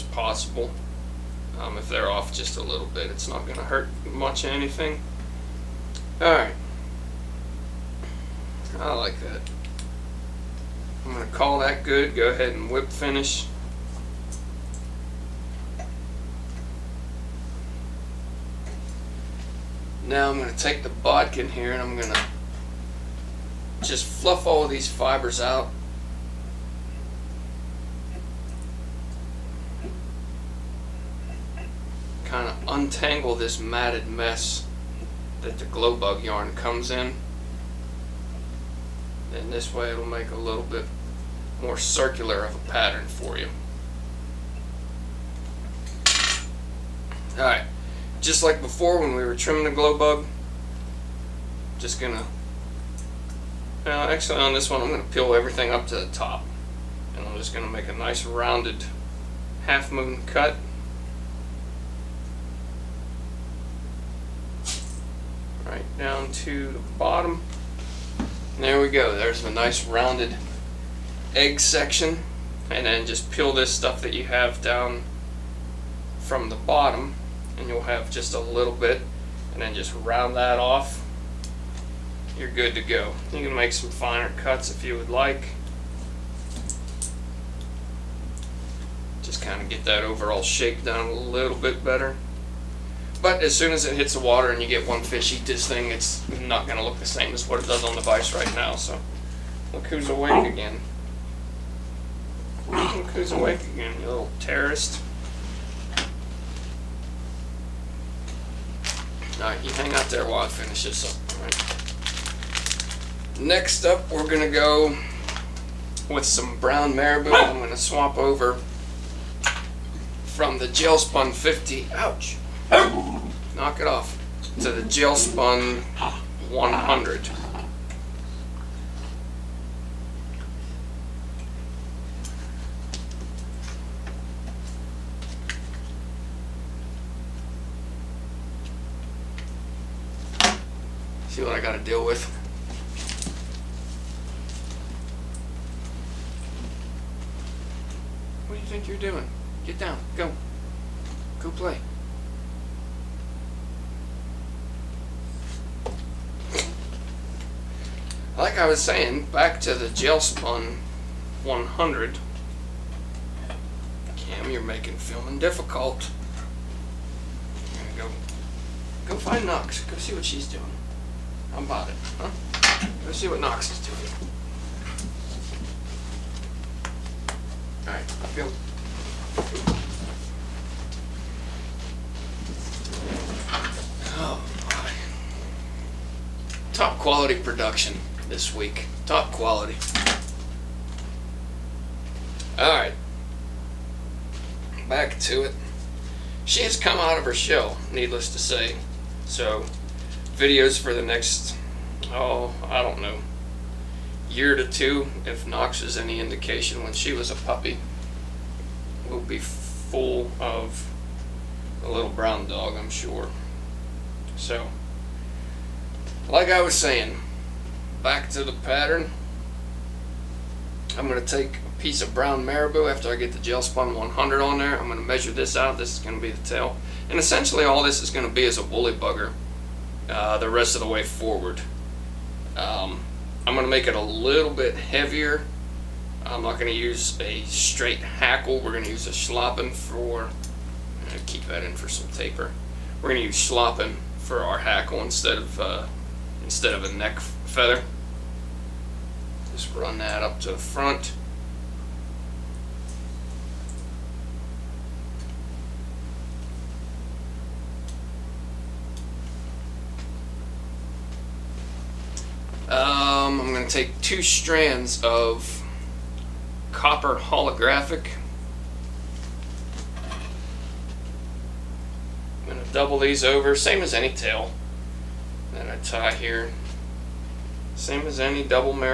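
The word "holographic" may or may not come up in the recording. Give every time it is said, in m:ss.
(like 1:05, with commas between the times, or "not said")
4:27.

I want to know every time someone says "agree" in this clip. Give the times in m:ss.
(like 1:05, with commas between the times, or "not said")
not said.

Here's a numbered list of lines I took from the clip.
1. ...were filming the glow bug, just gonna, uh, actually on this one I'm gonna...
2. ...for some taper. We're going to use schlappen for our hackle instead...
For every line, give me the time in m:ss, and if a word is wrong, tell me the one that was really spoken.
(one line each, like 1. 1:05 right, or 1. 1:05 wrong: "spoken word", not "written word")
1. 0:49 wrong: "trimming", not "filming"
2. 4:01 right.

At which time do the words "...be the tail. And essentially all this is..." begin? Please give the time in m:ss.
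3:46.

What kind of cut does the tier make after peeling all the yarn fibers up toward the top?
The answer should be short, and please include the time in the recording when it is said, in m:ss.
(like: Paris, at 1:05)
rounded half moon cut, at 0:58.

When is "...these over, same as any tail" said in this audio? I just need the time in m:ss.
4:32.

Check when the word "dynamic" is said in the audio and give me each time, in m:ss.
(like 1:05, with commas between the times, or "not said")
not said.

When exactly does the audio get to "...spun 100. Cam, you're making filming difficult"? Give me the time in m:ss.
2:40.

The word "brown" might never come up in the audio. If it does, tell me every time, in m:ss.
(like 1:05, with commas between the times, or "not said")
1:56, 3:32, 3:42.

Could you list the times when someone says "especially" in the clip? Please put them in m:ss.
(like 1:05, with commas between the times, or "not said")
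not said.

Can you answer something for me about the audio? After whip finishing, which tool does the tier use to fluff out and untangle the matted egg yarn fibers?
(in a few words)
bodkin.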